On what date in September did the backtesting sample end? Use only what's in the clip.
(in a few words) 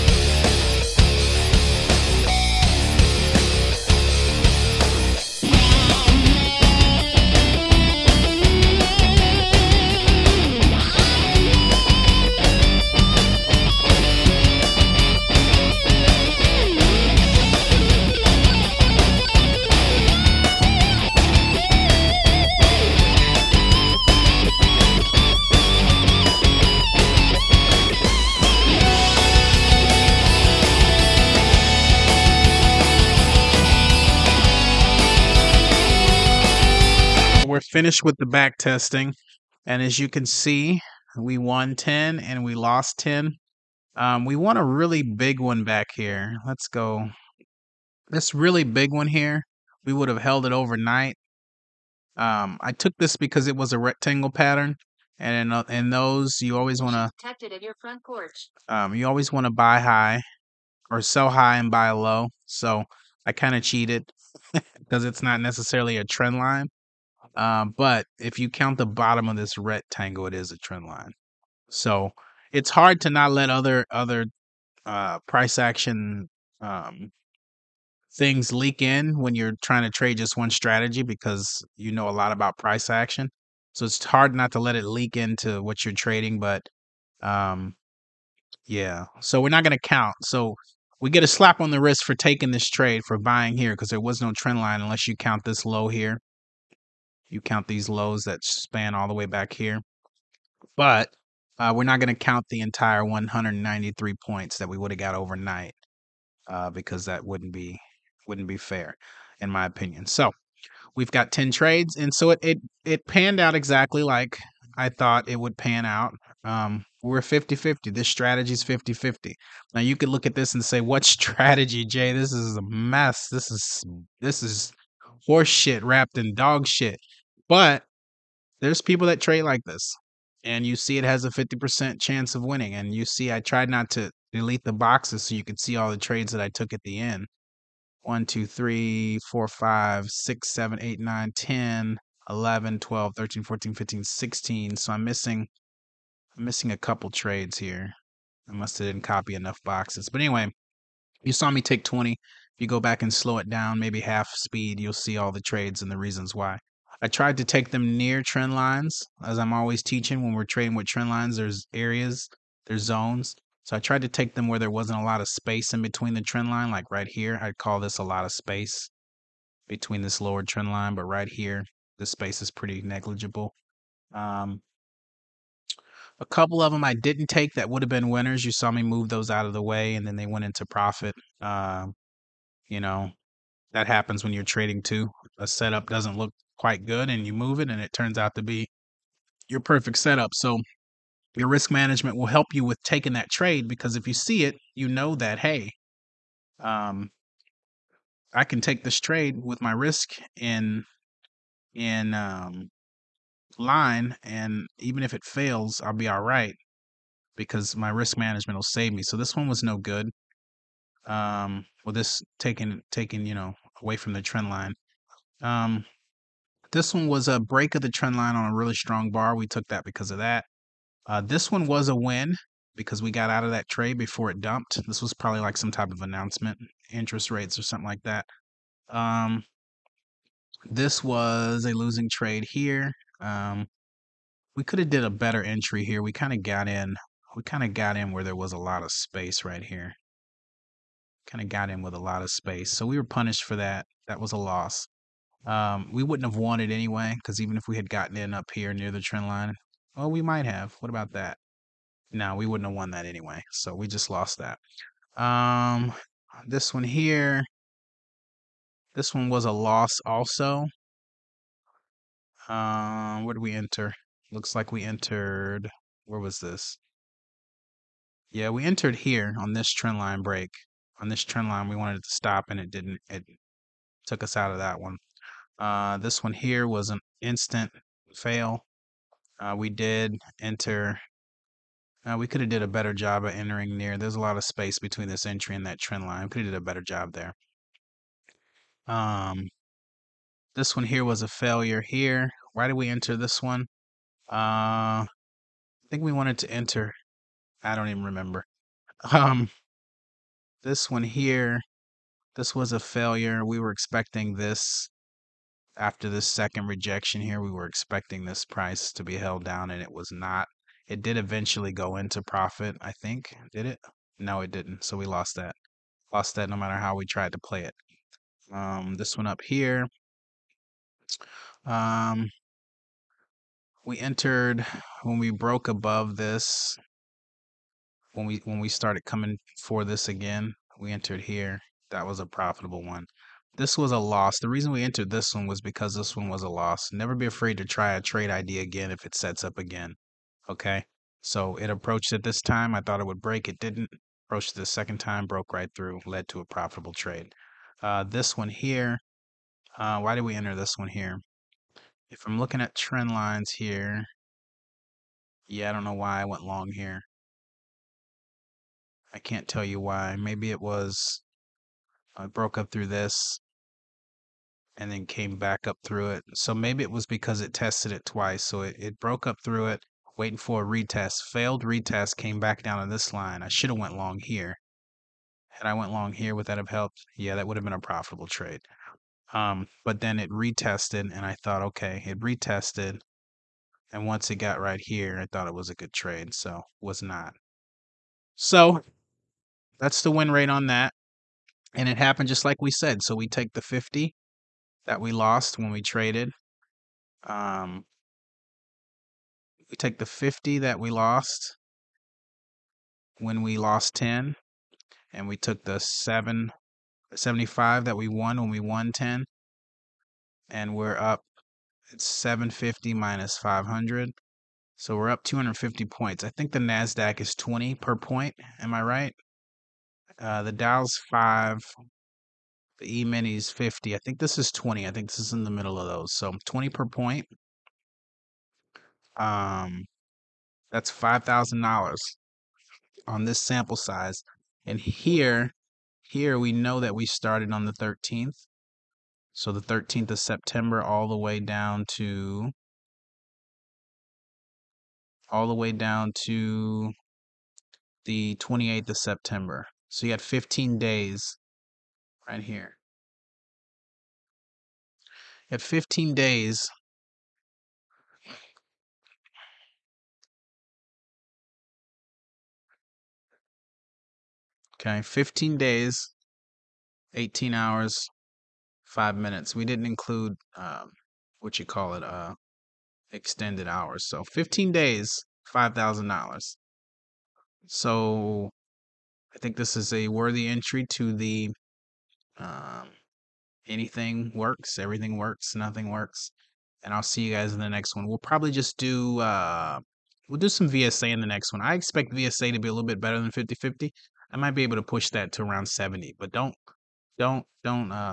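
September 28.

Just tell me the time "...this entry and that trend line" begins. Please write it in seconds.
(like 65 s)
285 s.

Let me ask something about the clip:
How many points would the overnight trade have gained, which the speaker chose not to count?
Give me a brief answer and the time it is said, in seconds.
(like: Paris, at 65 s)
193, at 103 s.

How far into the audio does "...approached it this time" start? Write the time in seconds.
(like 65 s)
341 s.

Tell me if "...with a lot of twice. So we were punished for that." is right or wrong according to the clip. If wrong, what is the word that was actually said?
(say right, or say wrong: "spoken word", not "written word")
wrong: "space", not "twice".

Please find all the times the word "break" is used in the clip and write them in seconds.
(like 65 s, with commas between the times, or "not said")
217 s, 270 s, 343 s.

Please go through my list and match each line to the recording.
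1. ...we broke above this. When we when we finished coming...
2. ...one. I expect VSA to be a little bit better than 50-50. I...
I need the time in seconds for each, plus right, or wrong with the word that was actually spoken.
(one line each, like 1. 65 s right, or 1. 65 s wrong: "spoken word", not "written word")
1. 325 s wrong: "started", not "finished"
2. 491 s right.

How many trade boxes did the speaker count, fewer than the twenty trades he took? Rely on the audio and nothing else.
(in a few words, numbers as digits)
16.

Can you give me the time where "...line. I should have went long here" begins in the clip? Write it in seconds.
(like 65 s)
373 s.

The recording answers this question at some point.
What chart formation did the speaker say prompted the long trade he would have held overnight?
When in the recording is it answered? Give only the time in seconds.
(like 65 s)
53 s.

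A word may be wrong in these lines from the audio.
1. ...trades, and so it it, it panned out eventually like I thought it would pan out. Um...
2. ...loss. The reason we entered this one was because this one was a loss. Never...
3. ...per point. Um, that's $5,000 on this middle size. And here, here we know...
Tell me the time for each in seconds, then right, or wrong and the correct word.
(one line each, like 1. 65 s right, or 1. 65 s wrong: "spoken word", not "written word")
1. 111 s wrong: "exactly", not "eventually"
2. 333 s right
3. 426 s wrong: "sample", not "middle".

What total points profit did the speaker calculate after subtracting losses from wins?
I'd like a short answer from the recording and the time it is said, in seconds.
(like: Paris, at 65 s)
250, at 415 s.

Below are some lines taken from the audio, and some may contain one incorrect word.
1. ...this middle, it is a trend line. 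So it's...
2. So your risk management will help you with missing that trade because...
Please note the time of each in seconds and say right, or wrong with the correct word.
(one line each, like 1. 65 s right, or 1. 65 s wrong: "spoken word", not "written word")
1. 69 s wrong: "rectangle", not "middle"
2. 190 s wrong: "taking", not "missing".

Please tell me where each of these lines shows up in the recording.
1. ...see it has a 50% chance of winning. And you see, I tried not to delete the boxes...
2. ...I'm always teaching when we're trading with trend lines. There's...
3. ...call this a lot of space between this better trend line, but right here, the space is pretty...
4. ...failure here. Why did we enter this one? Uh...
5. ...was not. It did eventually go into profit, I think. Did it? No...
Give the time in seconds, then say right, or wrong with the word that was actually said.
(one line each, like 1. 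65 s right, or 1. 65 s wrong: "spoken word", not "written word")
1. 130 s right
2. 159 s right
3. 167 s wrong: "lower", not "better"
4. 291 s right
5. 309 s right.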